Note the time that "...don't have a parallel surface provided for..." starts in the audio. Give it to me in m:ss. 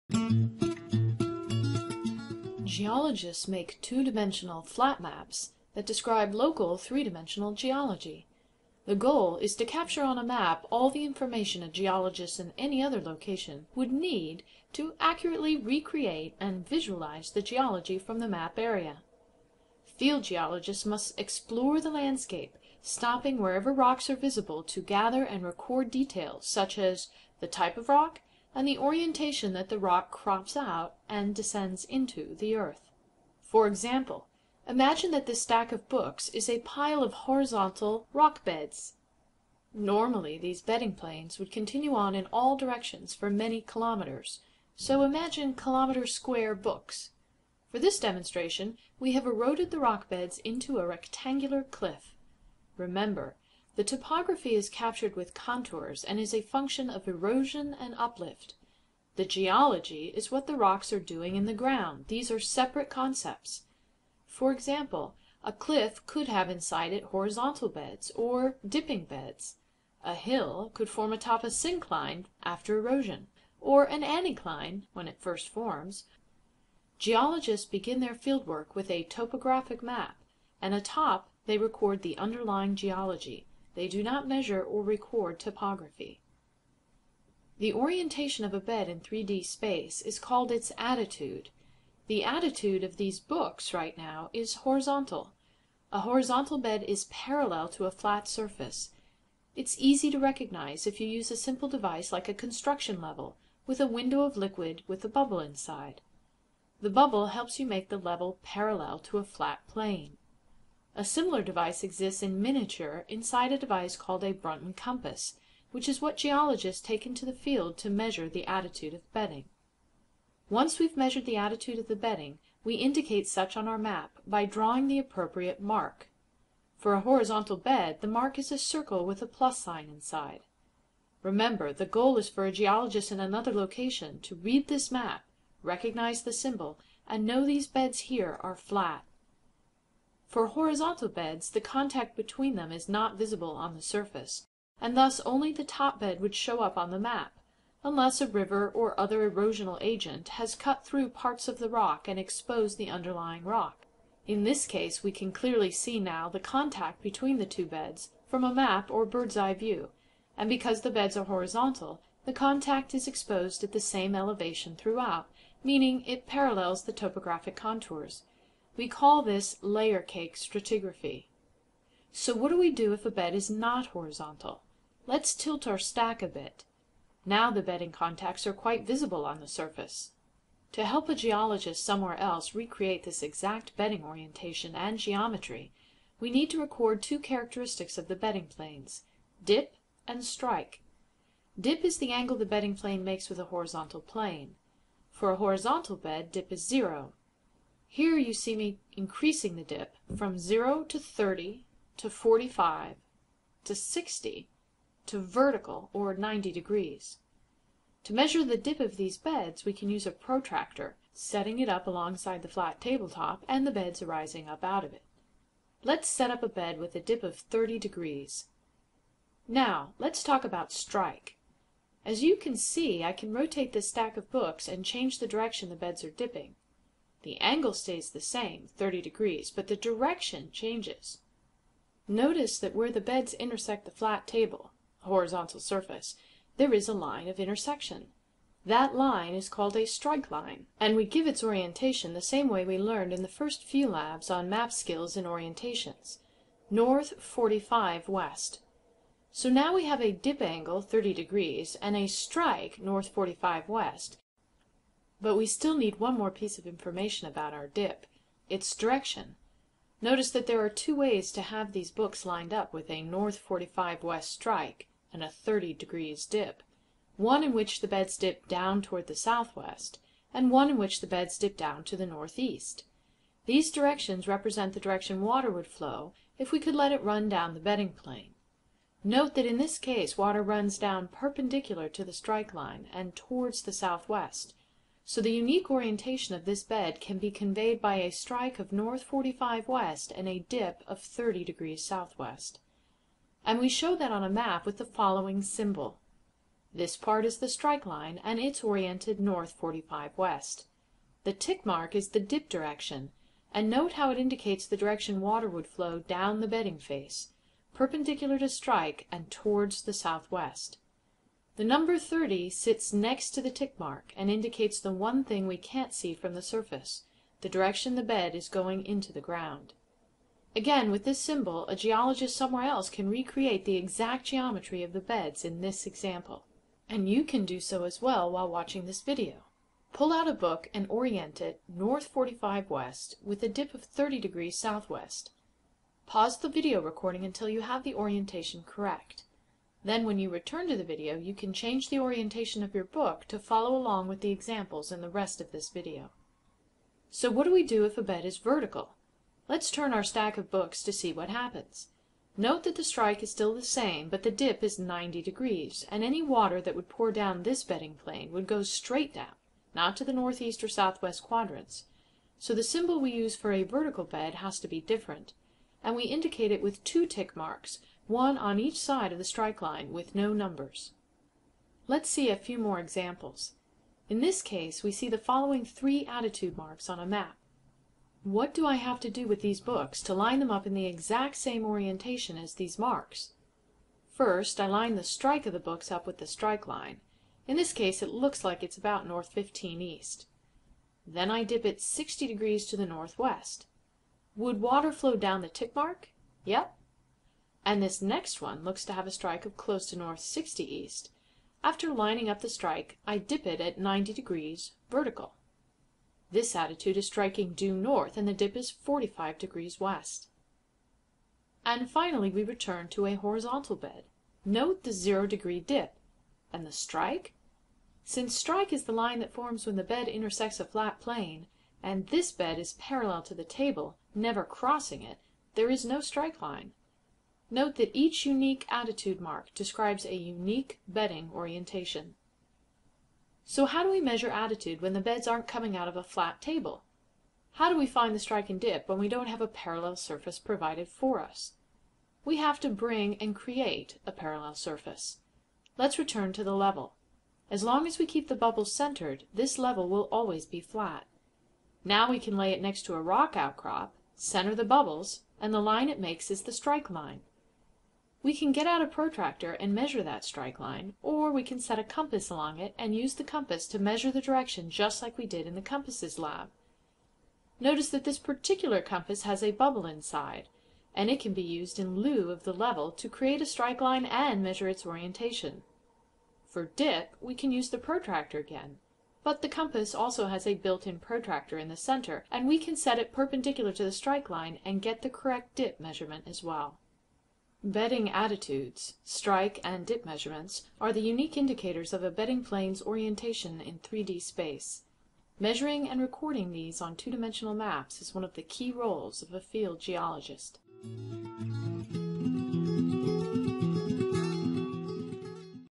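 7:19.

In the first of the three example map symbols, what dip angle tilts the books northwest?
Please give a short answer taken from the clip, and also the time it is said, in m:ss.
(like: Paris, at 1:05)
60 degrees, at 6:31.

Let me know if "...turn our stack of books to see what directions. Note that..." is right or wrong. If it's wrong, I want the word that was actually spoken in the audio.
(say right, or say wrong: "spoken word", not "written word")
wrong: "happens", not "directions".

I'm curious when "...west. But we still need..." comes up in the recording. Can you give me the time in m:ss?
4:13.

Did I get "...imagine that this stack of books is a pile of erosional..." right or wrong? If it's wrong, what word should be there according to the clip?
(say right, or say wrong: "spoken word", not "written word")
wrong: "horizontal", not "erosional".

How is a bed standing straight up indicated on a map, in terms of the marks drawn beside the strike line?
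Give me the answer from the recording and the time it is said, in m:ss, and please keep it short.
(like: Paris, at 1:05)
two tick marks, at 6:06.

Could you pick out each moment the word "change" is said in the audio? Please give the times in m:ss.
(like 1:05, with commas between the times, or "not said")
3:44, 3:50, 5:41.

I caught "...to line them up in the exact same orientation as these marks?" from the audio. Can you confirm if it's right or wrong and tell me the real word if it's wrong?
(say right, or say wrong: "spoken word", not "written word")
right.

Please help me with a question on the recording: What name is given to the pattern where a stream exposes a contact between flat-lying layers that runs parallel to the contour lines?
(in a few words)
layer cake stratigraphy.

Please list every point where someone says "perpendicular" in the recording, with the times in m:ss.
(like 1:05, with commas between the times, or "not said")
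4:41, 5:07, 8:03.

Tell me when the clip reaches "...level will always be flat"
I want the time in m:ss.
7:29.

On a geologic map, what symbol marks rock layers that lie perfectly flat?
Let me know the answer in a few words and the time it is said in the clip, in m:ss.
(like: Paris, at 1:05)
circle with a plus sign, at 2:08.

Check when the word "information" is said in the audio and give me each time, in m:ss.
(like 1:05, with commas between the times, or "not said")
0:11, 4:16.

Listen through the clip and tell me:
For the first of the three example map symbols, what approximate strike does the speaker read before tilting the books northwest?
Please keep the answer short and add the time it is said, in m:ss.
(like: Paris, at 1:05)
N15E, at 6:29.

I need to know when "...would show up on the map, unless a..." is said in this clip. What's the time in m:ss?
2:26.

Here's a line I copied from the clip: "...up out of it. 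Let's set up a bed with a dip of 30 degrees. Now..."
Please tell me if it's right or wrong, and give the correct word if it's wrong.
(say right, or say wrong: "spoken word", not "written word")
right.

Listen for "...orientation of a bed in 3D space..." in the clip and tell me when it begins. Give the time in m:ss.
1:27.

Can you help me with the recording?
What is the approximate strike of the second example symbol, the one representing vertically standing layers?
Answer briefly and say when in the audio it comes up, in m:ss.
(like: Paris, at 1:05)
N60E, at 6:39.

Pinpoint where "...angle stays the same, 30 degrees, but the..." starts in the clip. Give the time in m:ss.
3:47.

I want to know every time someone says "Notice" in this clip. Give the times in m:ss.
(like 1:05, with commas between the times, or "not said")
3:52, 4:20, 7:47.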